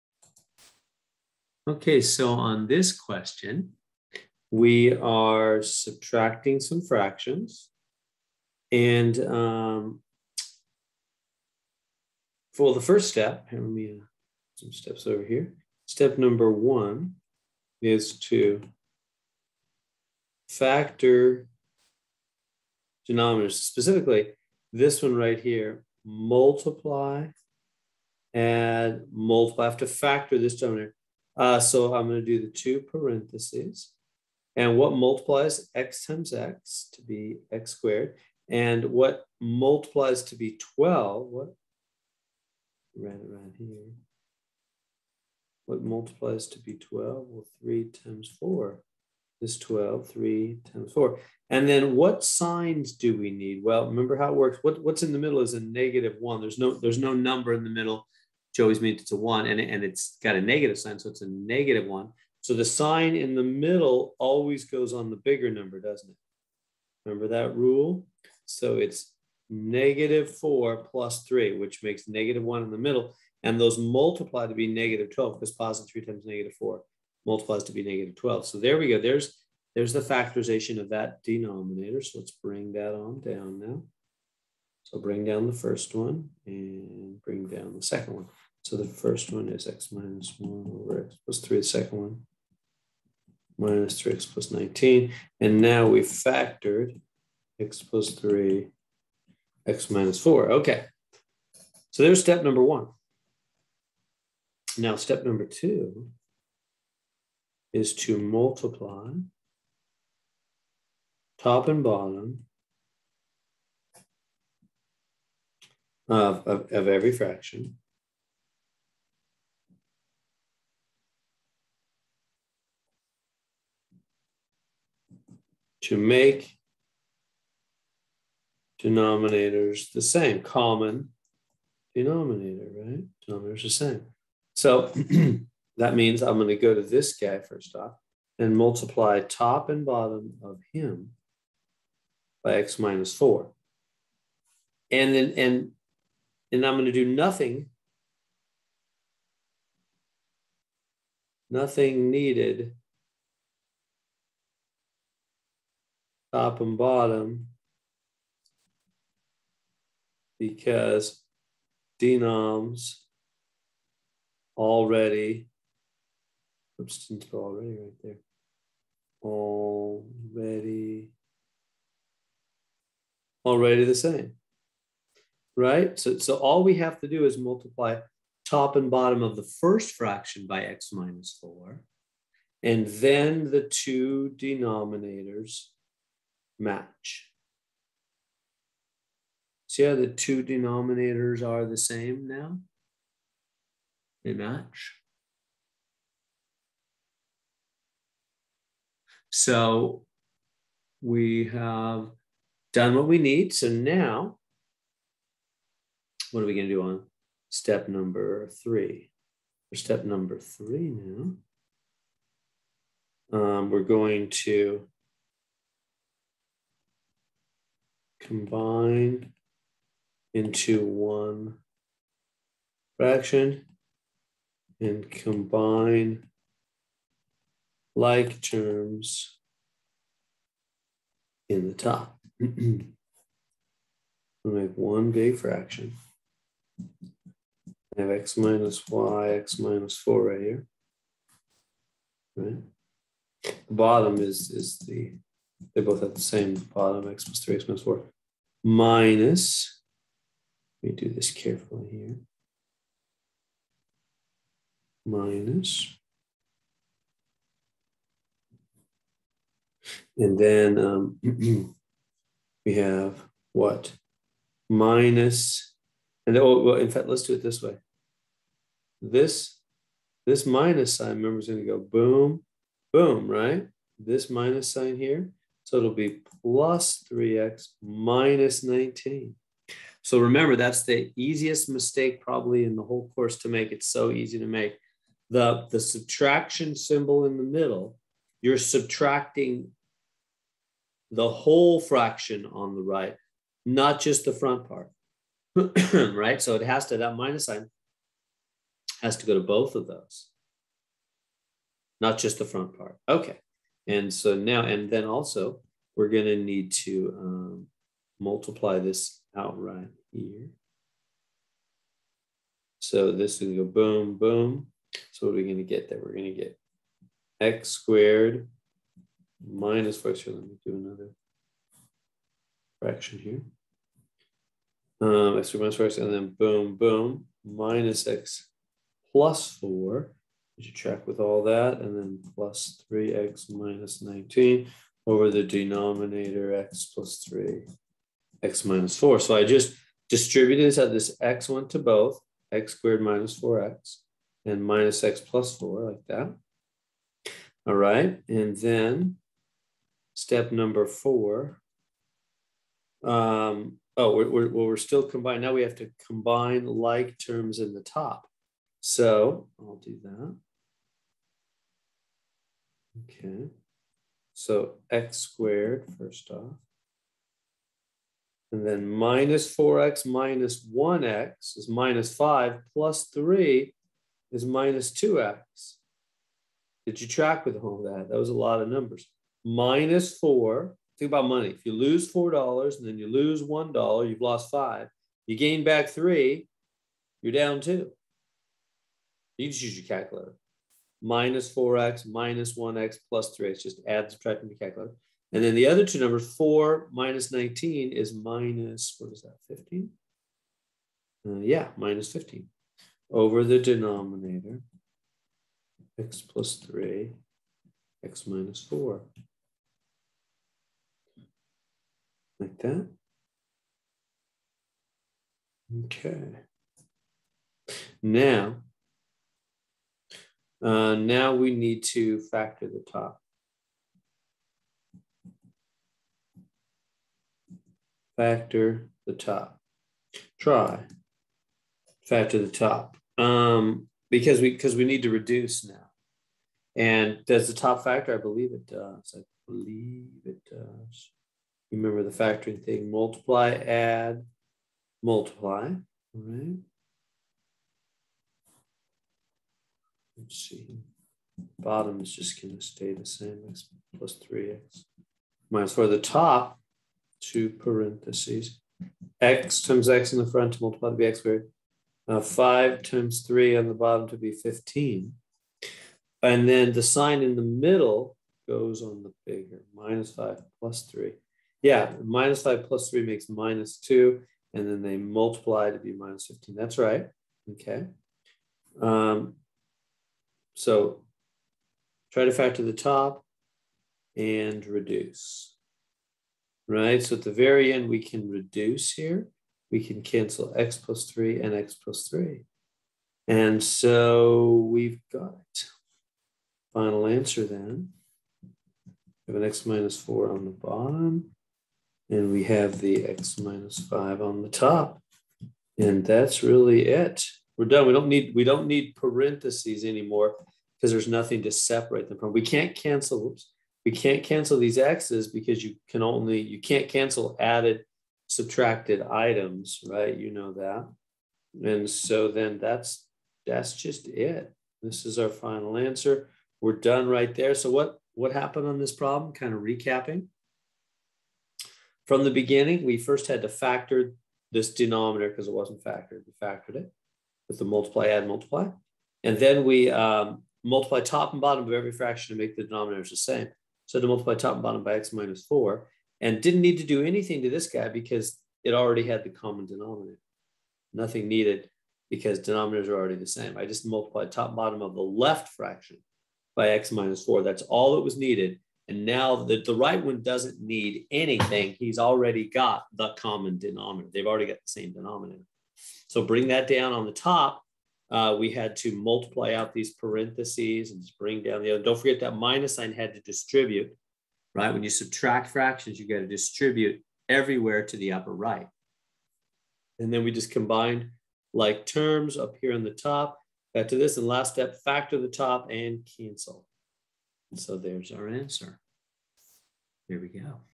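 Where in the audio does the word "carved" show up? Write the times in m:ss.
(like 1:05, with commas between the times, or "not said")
not said.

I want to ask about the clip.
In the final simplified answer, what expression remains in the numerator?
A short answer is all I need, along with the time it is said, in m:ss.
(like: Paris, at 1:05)
x - 5, at 8:23.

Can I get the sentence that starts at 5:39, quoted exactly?
So I just distributed this at This x went to both, x squared minus 4x and minus x plus 4 like that.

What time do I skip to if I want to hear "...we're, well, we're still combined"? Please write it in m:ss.
5:54.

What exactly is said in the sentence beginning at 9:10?
Nothing needed because denominators are already the same.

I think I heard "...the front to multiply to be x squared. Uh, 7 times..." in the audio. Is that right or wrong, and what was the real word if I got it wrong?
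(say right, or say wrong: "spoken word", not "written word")
wrong: "5", not "7".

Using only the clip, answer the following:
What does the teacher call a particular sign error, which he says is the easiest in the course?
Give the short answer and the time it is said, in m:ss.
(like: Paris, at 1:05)
easiest mistake, at 4:41.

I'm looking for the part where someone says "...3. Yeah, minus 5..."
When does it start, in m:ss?
7:50.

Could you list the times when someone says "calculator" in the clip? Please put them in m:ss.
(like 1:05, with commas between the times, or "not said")
6:29, 6:34.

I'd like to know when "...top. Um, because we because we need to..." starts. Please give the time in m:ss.
7:12.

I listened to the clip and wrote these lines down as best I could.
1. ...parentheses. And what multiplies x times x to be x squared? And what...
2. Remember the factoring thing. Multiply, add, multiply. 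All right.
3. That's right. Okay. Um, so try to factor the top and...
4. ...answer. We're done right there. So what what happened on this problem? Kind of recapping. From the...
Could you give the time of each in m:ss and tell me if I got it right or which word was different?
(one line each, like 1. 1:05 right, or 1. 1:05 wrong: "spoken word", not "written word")
1. 0:32 right
2. 7:21 right
3. 7:56 right
4. 8:45 right.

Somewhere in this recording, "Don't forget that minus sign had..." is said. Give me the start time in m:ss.
9:31.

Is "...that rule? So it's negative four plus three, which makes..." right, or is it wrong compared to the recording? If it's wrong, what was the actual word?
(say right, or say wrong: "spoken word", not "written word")
right.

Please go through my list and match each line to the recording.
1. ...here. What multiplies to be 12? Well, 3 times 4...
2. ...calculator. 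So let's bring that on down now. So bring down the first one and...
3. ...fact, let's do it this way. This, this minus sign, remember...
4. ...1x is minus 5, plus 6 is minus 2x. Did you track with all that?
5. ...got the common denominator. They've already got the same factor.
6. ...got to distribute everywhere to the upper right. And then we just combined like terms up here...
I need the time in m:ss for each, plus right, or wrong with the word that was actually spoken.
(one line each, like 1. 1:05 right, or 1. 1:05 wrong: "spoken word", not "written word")
1. 0:43 right
2. 1:21 wrong: "denominator", not "calculator"
3. 4:26 right
4. 6:10 wrong: "3", not "6"
5. 9:22 wrong: "denominator", not "factor"
6. 9:36 right.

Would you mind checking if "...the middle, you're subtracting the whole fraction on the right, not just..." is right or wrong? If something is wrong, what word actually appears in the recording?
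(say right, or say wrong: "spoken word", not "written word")
right.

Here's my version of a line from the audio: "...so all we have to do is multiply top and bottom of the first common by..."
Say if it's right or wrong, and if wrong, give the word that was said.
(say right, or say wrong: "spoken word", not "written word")
wrong: "fraction", not "common".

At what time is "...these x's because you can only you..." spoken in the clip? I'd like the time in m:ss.
8:34.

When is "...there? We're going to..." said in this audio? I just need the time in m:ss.
5:15.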